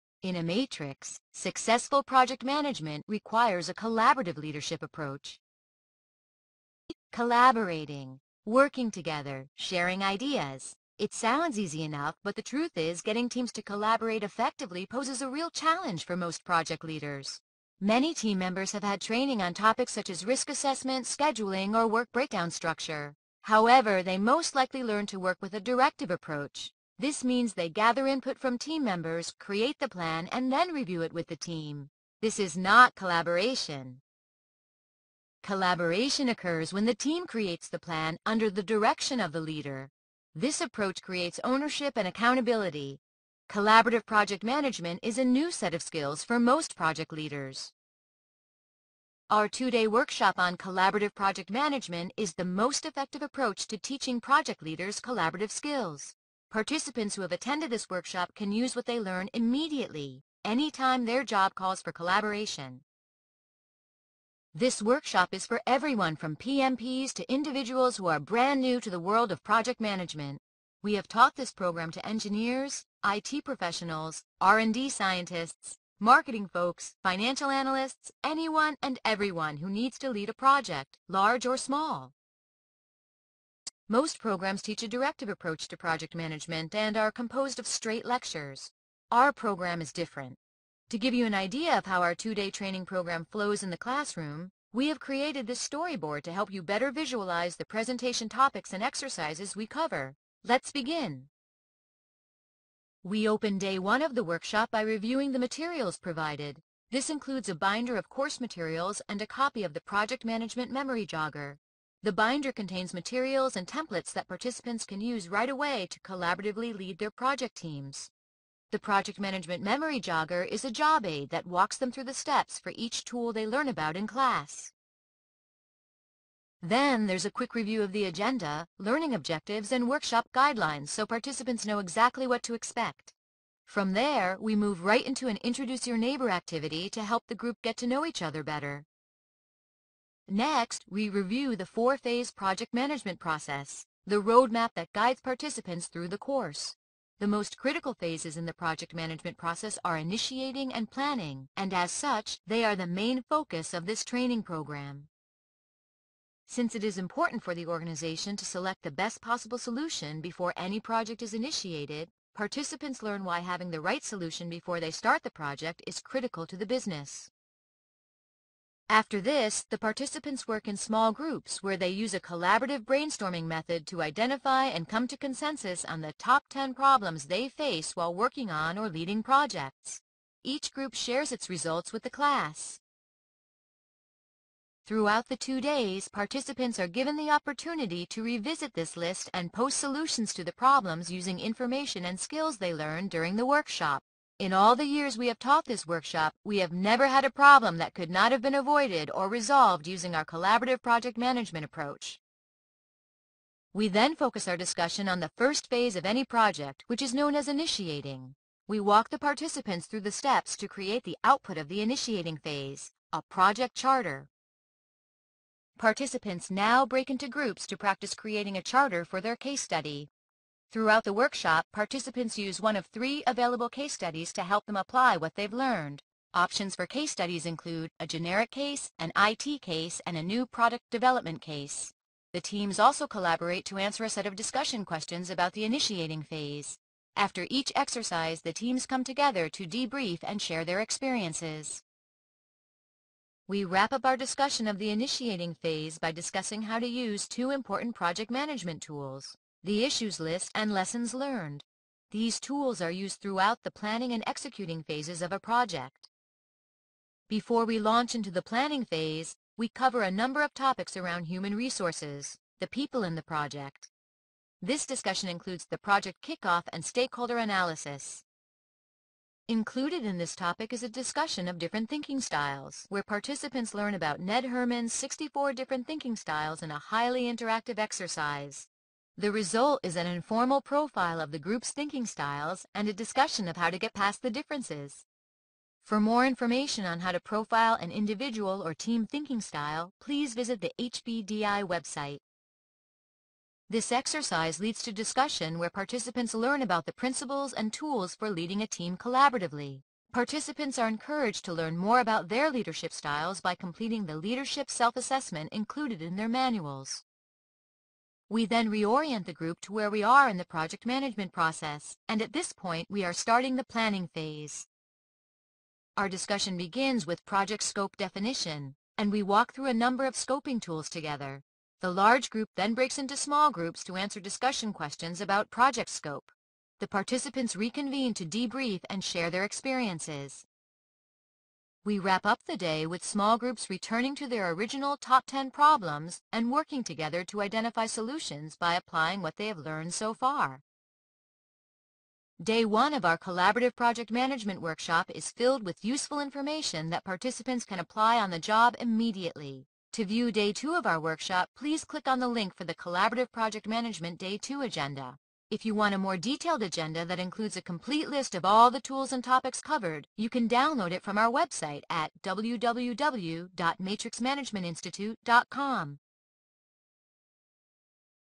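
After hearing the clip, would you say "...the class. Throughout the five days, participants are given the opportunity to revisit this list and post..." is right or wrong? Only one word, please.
wrong.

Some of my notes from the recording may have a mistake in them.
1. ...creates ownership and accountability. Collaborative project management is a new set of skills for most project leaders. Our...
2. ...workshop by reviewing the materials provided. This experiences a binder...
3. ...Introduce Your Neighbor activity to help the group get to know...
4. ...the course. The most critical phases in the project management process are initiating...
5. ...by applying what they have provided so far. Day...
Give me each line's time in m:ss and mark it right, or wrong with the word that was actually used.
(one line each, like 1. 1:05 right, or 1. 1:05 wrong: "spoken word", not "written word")
1. 0:41 right
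2. 1:44 wrong: "includes", not "experiences"
3. 2:15 right
4. 2:26 right
5. 5:38 wrong: "learned", not "provided".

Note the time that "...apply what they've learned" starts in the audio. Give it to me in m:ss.
3:44.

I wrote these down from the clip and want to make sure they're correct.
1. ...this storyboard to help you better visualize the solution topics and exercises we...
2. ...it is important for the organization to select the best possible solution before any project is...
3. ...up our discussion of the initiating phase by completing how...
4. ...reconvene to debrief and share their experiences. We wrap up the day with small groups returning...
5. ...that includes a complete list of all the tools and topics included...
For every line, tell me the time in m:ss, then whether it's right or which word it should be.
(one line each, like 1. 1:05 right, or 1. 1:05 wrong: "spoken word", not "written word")
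1. 1:35 wrong: "presentation", not "solution"
2. 2:36 right
3. 4:03 wrong: "discussing", not "completing"
4. 5:27 right
5. 5:57 wrong: "covered", not "included".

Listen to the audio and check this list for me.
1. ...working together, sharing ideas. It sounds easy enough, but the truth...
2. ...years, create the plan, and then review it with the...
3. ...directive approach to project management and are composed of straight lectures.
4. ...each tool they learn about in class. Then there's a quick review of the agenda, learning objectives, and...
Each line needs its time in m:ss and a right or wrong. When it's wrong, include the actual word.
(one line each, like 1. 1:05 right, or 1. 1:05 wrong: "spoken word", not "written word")
1. 0:08 right
2. 0:28 wrong: "members", not "years"
3. 1:24 right
4. 2:02 right.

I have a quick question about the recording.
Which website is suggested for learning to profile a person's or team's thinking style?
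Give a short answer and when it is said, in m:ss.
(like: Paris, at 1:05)
HBDI, at 4:50.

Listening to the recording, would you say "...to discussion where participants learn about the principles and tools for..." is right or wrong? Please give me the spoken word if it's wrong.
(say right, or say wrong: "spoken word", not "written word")
right.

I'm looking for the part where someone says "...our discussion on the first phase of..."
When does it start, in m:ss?
3:24.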